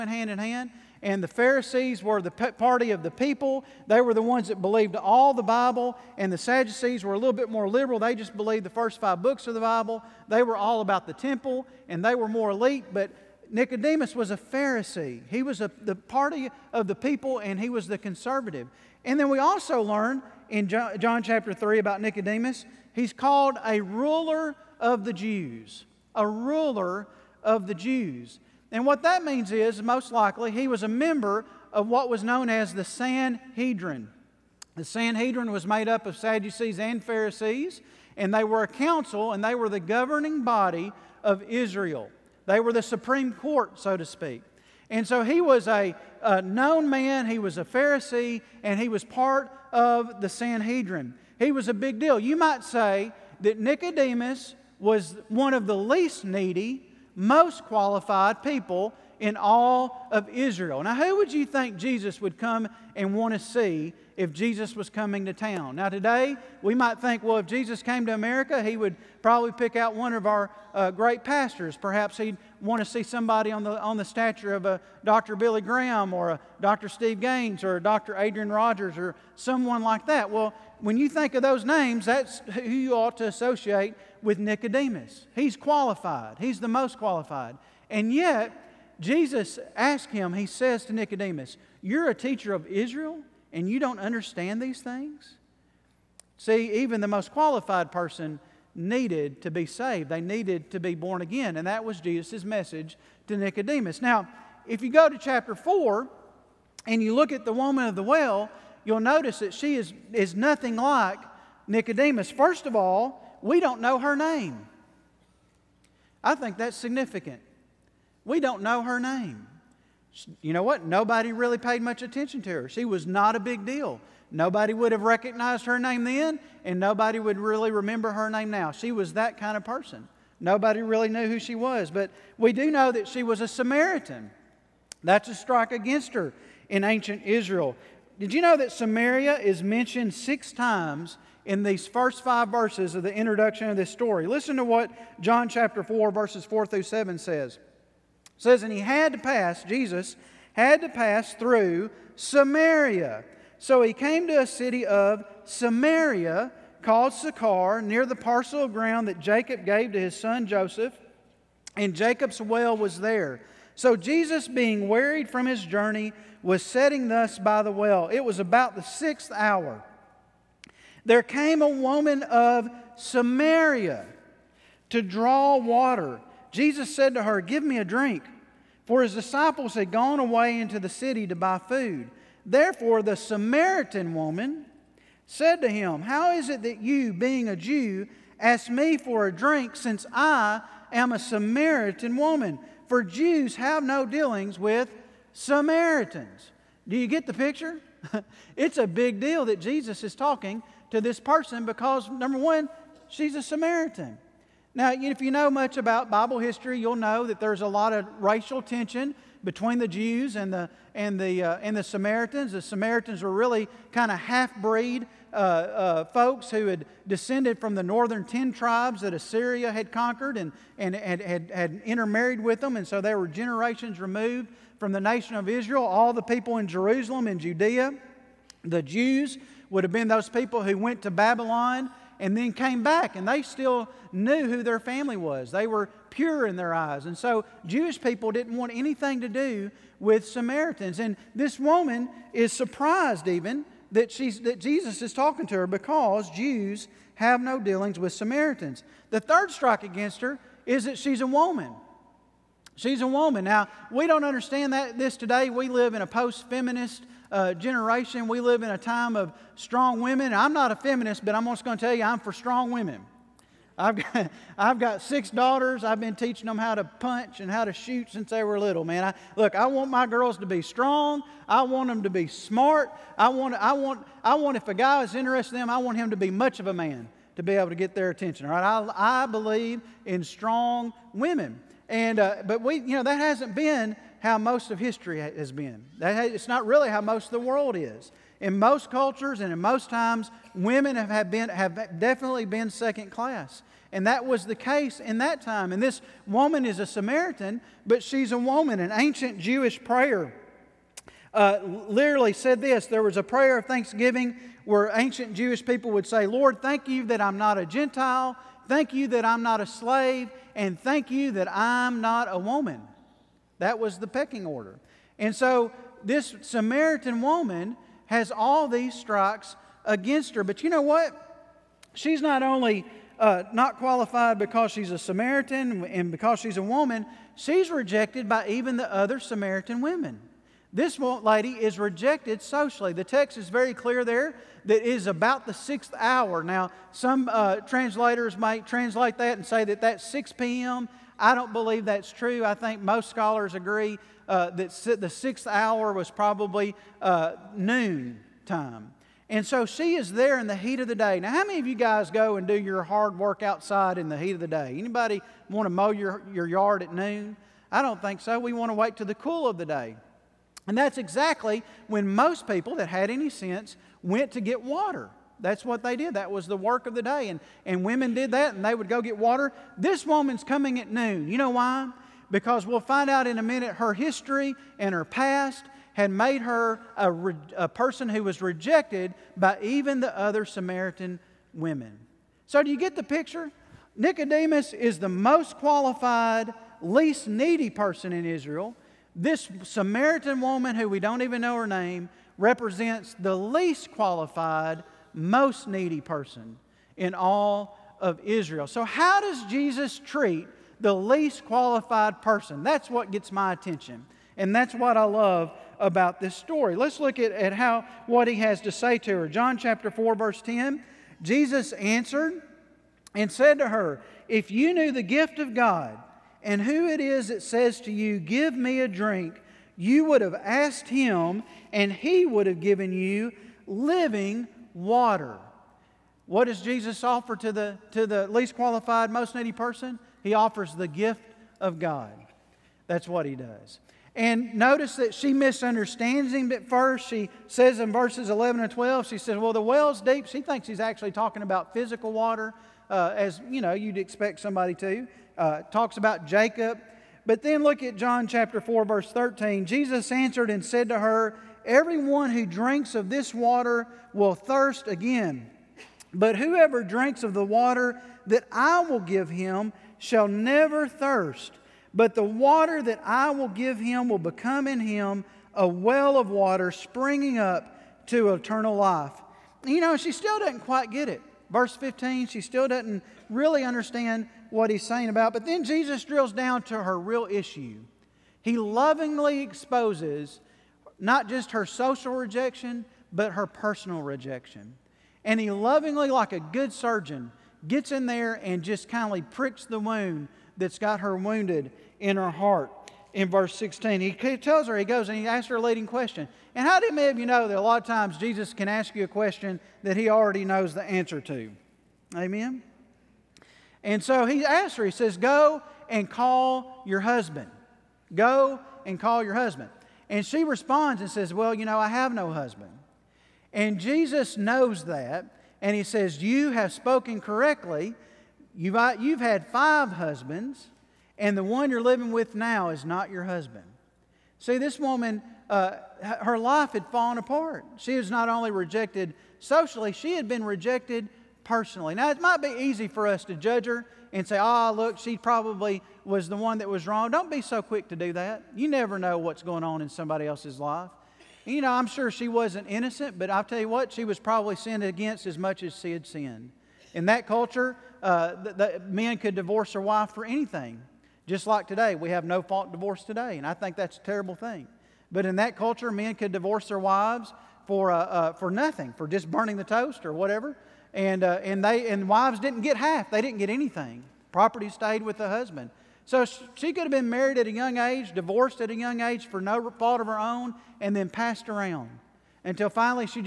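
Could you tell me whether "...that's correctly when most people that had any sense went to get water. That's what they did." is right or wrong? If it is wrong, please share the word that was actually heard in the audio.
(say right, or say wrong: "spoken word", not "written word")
wrong: "exactly", not "correctly".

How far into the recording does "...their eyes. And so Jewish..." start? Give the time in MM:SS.
03:56.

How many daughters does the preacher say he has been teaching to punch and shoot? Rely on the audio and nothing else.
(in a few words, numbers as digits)
6.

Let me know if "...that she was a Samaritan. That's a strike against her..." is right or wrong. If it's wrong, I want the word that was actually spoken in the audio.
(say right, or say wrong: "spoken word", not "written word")
right.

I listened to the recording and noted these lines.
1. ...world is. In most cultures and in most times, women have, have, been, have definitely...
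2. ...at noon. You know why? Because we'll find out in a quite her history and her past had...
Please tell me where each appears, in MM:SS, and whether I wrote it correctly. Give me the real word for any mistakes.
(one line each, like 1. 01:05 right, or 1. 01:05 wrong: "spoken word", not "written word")
1. 04:47 right
2. 06:10 wrong: "minute", not "quite".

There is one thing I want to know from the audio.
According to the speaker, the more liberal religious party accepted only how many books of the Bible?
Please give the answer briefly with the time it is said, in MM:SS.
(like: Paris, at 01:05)
5, at 00:08.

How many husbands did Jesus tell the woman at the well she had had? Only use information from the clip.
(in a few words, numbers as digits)
5.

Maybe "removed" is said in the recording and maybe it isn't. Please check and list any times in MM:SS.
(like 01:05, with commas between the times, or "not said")
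03:43.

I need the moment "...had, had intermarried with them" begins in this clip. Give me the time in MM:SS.
03:41.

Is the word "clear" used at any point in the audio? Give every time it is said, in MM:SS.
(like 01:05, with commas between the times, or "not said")
05:33.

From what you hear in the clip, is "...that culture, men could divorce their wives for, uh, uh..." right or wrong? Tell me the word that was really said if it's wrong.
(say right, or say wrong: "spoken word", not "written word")
right.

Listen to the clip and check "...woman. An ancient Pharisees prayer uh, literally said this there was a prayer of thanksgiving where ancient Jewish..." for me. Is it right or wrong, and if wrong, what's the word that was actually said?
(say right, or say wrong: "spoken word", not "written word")
wrong: "Jewish", not "Pharisees".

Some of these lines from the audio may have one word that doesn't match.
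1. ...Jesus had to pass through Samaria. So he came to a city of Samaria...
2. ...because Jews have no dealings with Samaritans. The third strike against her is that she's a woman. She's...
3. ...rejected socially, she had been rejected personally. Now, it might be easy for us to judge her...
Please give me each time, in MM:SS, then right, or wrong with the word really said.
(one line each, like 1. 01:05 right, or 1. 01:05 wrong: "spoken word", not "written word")
1. 02:29 right
2. 04:05 right
3. 08:48 right.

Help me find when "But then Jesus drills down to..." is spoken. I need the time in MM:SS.
07:55.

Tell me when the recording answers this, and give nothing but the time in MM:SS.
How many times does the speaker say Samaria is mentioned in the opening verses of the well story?
02:20.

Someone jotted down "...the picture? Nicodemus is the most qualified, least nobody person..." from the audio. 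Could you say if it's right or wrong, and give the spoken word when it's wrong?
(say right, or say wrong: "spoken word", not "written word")
wrong: "needy", not "nobody".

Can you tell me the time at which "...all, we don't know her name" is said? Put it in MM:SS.
01:52.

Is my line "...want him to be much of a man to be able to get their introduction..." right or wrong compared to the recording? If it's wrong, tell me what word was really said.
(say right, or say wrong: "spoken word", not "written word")
wrong: "attention", not "introduction".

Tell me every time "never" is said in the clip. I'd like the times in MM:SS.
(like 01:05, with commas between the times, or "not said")
07:40, 08:58.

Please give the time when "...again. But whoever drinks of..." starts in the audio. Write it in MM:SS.
07:34.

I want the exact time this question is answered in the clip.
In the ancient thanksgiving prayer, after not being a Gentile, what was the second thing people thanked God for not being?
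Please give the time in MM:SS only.
05:09.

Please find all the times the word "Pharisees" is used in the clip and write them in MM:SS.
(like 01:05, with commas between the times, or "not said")
00:01, 00:14, 00:37, 00:47.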